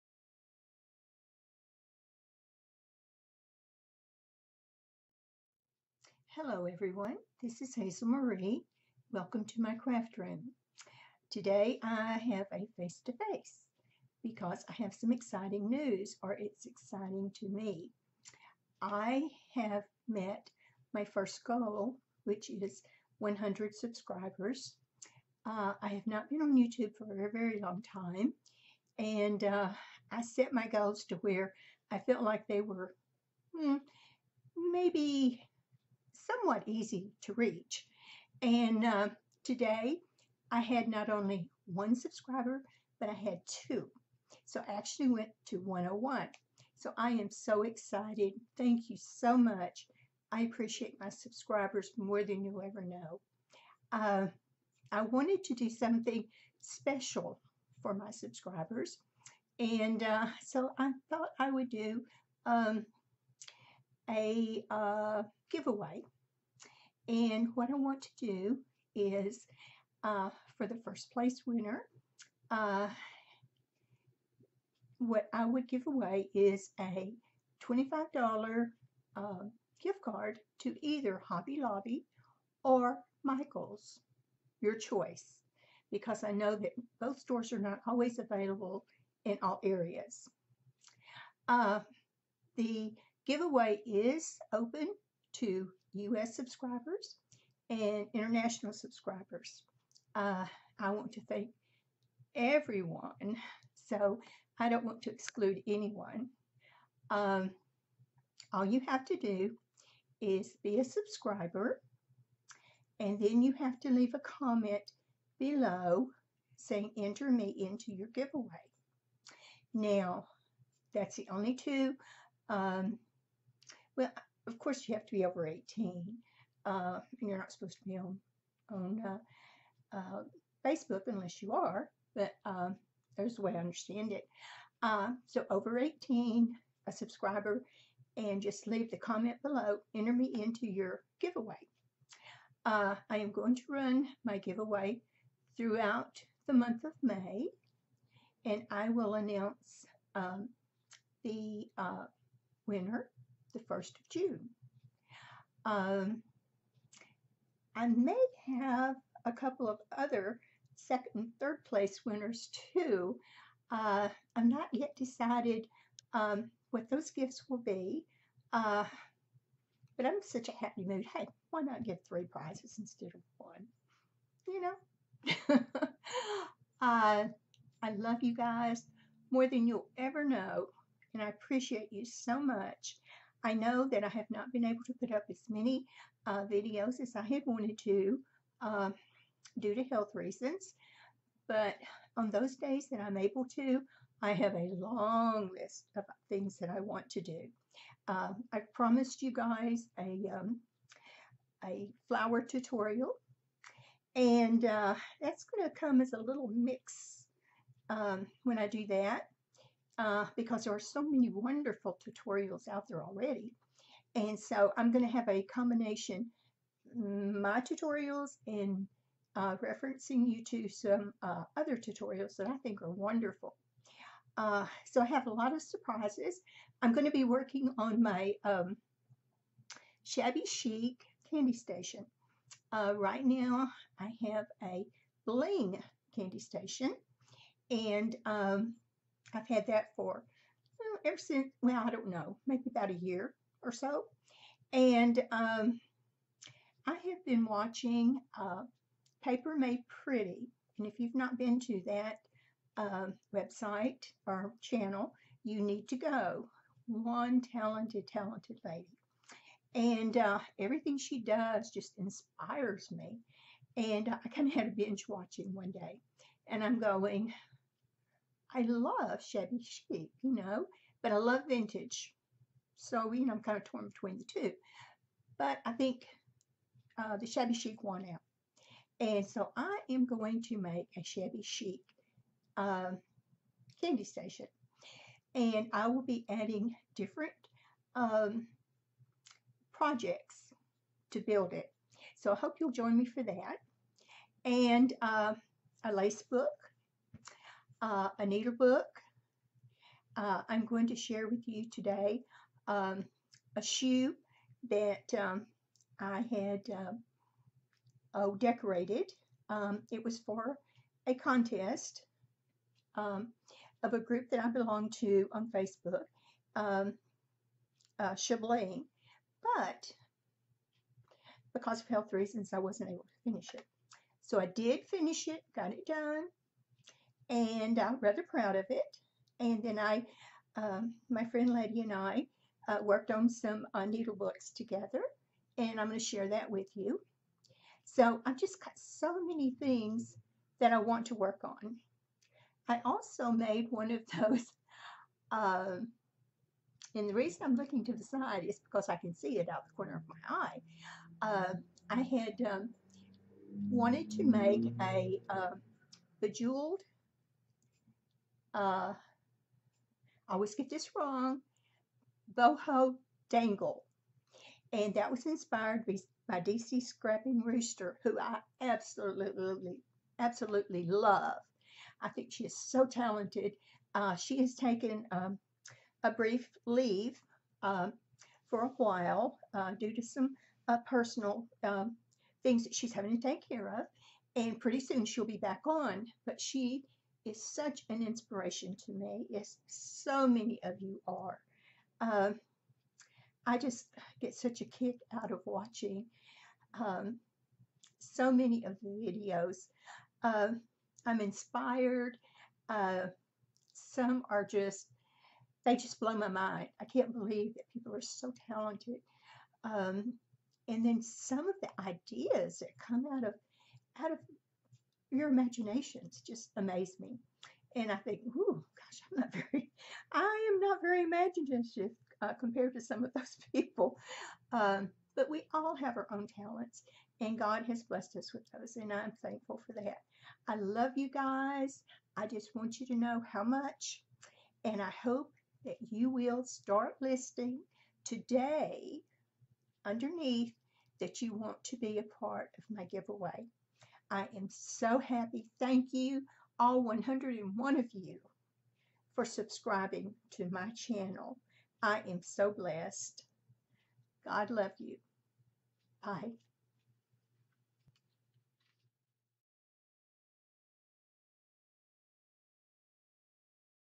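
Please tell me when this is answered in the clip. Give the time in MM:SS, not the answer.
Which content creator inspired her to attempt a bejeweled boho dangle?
06:06.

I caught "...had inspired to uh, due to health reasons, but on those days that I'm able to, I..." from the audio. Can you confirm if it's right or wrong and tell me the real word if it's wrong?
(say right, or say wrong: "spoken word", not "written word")
wrong: "wanted", not "inspired".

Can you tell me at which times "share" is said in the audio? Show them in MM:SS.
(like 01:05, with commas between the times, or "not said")
05:00, 05:36.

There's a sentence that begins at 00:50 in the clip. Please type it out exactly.
I appreciate my subscribers more than you ever know.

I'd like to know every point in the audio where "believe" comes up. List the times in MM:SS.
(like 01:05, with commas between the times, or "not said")
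06:47.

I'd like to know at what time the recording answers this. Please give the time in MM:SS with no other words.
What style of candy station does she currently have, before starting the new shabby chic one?
03:55.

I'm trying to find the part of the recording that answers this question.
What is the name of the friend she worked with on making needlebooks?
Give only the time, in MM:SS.
05:31.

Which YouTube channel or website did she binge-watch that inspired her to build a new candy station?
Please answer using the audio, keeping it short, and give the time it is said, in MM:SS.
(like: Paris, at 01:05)
Paper Made Pretty, at 04:09.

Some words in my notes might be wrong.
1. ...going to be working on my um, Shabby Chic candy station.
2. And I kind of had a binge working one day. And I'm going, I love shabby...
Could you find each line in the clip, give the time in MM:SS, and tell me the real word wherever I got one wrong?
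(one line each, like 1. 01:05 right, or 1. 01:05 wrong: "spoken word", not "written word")
1. 03:46 right
2. 04:23 wrong: "watching", not "working".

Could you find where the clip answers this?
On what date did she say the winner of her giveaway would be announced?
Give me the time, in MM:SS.
02:33.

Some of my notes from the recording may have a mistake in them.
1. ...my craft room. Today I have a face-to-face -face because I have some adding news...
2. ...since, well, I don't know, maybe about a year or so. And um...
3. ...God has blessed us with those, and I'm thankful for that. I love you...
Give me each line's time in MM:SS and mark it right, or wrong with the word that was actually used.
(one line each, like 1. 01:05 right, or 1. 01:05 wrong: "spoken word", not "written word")
1. 00:09 wrong: "exciting", not "adding"
2. 04:01 right
3. 07:07 right.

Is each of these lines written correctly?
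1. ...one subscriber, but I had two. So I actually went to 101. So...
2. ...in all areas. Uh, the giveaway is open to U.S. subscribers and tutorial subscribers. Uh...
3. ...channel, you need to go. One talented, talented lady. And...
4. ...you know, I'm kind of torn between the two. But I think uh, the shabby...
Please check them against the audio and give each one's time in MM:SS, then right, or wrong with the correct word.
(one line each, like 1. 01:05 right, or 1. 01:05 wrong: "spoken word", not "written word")
1. 00:41 right
2. 01:29 wrong: "international", not "tutorial"
3. 04:14 right
4. 04:33 right.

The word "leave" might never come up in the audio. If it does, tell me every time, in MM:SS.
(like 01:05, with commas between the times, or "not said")
01:53, 02:18, 06:16.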